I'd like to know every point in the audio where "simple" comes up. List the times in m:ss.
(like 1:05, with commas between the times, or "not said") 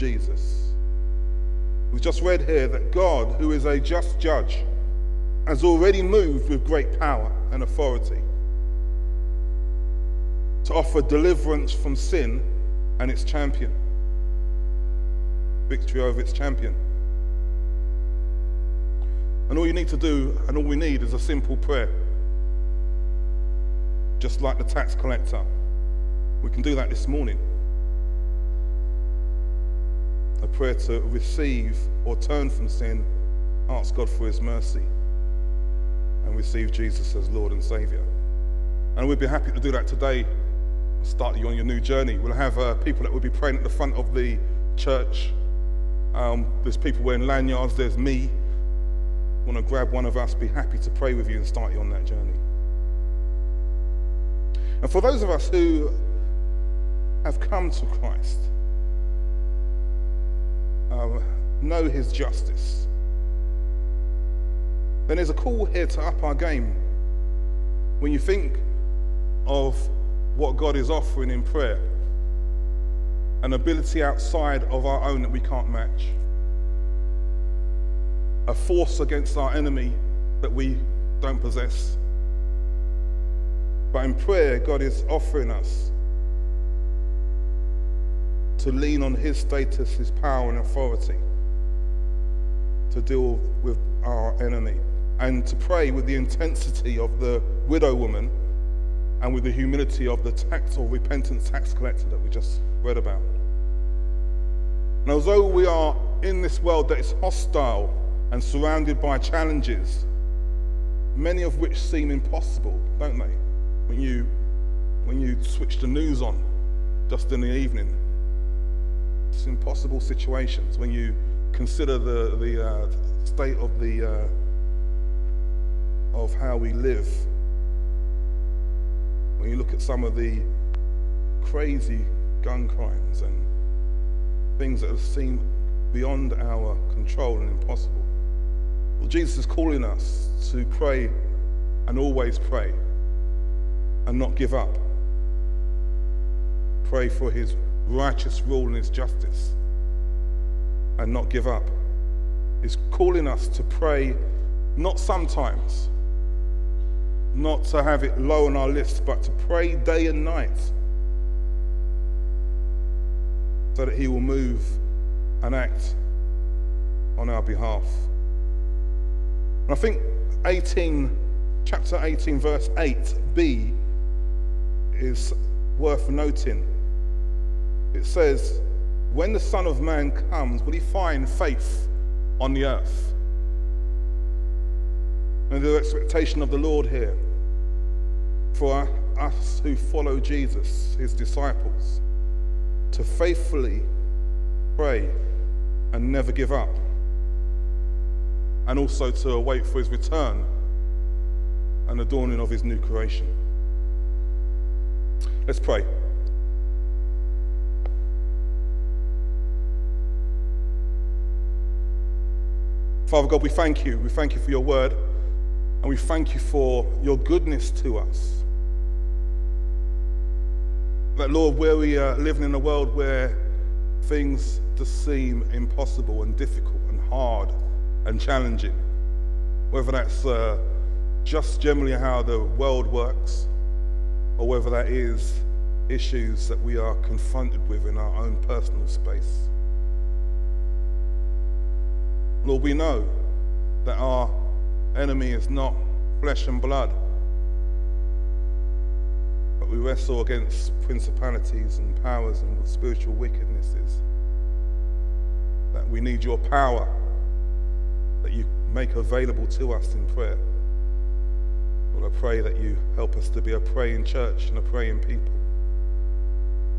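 0:21.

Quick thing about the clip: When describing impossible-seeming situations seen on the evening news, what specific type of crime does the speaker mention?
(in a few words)
Gun crimes.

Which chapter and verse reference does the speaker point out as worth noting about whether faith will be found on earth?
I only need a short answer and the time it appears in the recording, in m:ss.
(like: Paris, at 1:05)
18:8b, at 2:51.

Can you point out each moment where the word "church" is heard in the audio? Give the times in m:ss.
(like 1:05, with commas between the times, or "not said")
0:44, 4:24.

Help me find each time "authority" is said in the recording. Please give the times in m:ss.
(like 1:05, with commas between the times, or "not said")
0:07, 1:30.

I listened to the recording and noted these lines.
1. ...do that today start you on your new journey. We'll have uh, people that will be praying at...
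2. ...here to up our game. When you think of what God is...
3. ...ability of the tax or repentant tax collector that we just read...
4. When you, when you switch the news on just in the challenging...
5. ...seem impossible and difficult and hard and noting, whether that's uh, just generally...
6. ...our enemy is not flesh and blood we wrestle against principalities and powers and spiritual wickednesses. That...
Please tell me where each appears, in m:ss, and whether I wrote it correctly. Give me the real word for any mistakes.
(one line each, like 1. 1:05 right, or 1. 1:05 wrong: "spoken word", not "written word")
1. 0:39 right
2. 1:05 right
3. 1:39 wrong: "humility", not "ability"
4. 1:53 wrong: "evening", not "challenging"
5. 3:45 wrong: "challenging", not "noting"
6. 4:03 right.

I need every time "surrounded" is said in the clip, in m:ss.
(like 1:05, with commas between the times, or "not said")
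1:48.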